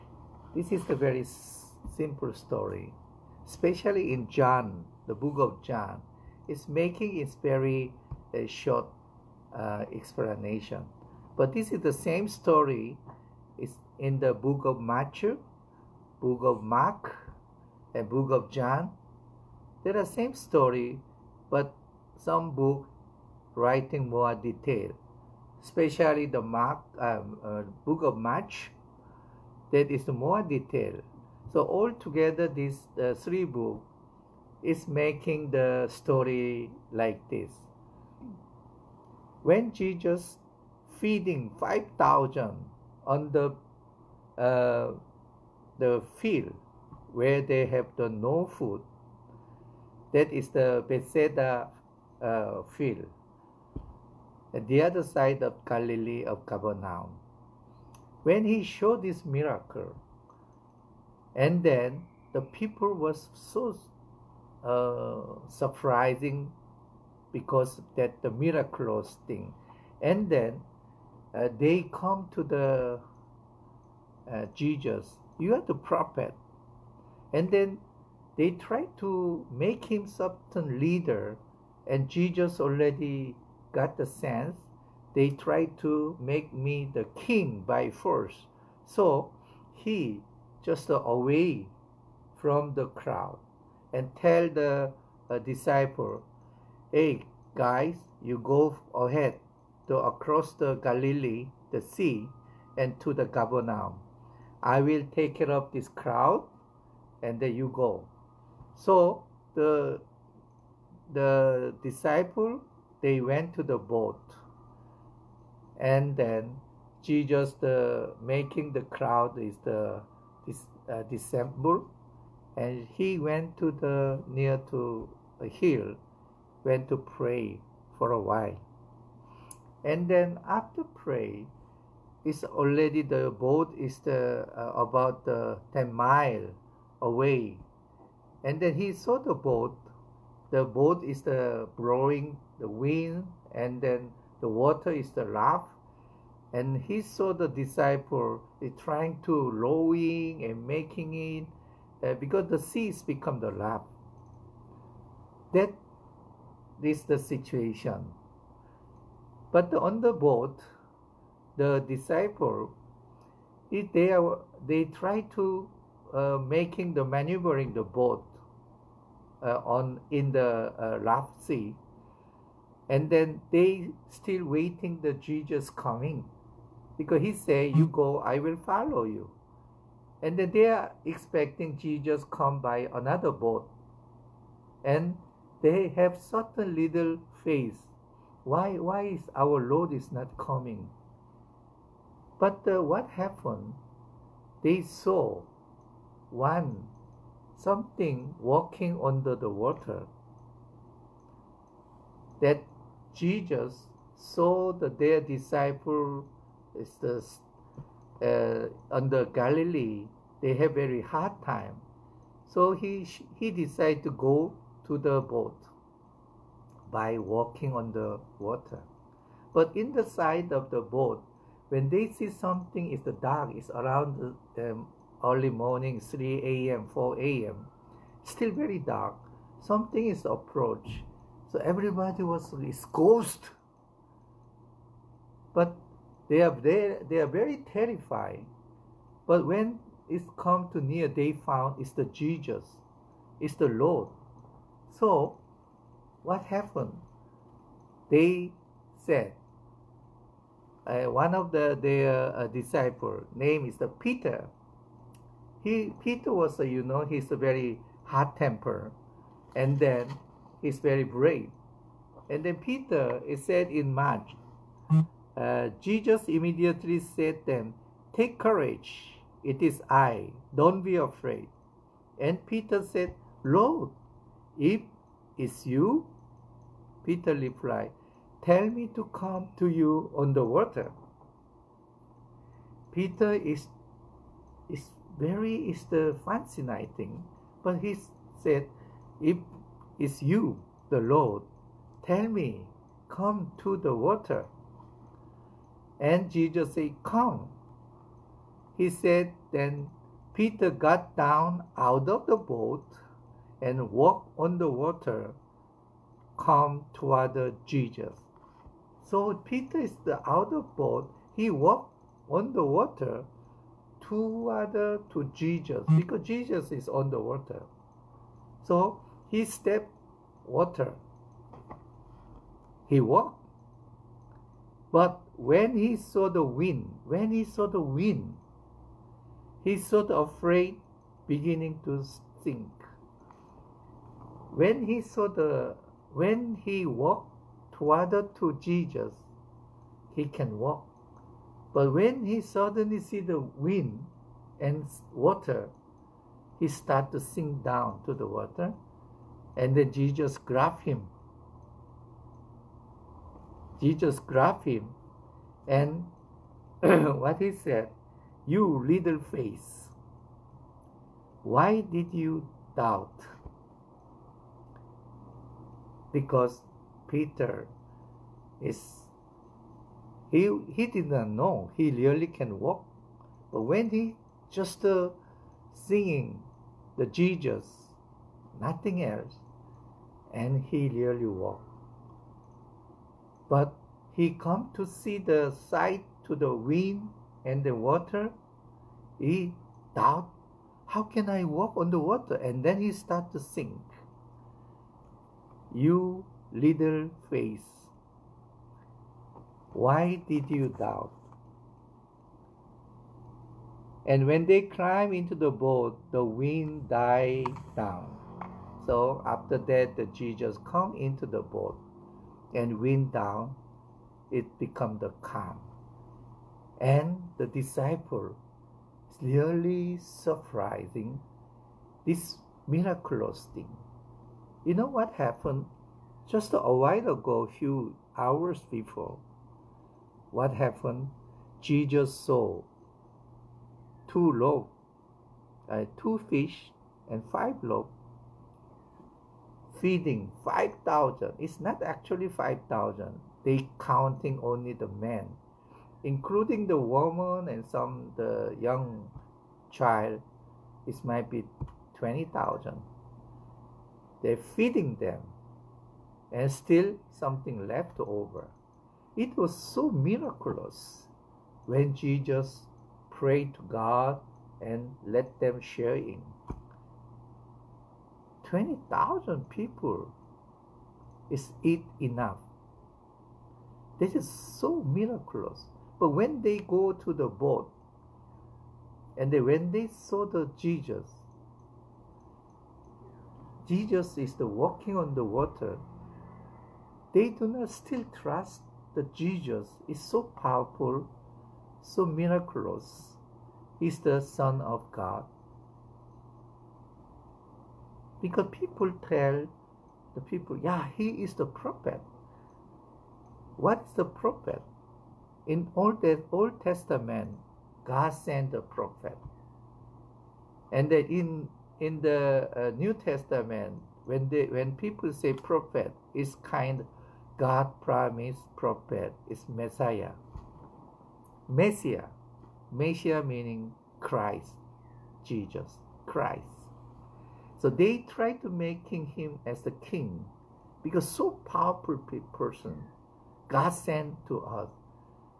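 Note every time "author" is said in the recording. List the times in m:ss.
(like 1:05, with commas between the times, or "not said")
not said.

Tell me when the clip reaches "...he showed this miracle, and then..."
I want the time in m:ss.
0:58.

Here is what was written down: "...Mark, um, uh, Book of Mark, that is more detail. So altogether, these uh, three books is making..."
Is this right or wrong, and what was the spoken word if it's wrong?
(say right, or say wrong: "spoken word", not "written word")
right.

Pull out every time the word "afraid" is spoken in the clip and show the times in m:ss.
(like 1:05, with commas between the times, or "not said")
4:30, 5:30.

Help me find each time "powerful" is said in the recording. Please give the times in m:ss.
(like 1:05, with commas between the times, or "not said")
8:10, 8:51.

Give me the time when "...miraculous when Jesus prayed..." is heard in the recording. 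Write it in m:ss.
7:39.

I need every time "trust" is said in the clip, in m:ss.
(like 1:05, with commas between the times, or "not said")
8:08.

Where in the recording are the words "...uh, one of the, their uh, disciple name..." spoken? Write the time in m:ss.
4:10.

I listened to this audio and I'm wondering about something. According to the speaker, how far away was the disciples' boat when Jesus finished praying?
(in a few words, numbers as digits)
10 miles.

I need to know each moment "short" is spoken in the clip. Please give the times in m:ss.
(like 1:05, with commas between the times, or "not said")
0:08.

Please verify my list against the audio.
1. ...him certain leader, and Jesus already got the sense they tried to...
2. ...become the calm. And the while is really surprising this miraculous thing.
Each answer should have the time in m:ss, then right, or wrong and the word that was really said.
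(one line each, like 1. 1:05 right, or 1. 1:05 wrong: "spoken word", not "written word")
1. 1:19 right
2. 6:54 wrong: "disciple", not "while".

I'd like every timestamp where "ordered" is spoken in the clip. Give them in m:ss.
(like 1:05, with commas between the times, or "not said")
not said.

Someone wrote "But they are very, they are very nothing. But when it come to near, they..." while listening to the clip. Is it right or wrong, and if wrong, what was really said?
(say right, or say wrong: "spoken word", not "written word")
wrong: "terrifying", not "nothing".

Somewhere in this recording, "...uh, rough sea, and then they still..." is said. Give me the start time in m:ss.
2:50.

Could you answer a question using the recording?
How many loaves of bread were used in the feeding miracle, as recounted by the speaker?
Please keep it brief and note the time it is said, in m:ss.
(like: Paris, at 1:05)
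5, at 7:17.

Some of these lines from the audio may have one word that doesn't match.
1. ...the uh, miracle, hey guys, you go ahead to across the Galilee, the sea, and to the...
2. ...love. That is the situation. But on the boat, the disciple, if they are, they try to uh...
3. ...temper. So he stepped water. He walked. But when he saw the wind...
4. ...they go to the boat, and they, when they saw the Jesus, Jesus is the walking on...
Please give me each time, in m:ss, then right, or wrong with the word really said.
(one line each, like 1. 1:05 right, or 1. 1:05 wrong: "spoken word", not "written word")
1. 1:34 wrong: "disciple", not "miracle"
2. 2:33 right
3. 5:17 wrong: "water", not "temper"
4. 7:56 right.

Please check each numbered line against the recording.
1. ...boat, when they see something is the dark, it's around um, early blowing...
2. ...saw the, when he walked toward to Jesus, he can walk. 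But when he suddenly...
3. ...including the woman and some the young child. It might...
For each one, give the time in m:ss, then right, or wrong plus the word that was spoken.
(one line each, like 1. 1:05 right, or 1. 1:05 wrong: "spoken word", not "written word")
1. 3:40 wrong: "morning", not "blowing"
2. 5:34 right
3. 7:26 right.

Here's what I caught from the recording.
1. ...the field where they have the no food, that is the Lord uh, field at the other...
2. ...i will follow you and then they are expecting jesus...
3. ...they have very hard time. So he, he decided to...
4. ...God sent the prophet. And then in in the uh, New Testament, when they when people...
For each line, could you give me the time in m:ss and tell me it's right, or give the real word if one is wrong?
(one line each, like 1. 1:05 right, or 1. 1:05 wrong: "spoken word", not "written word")
1. 0:45 wrong: "Bethsaida", not "Lord"
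2. 2:58 right
3. 3:30 right
4. 8:27 right.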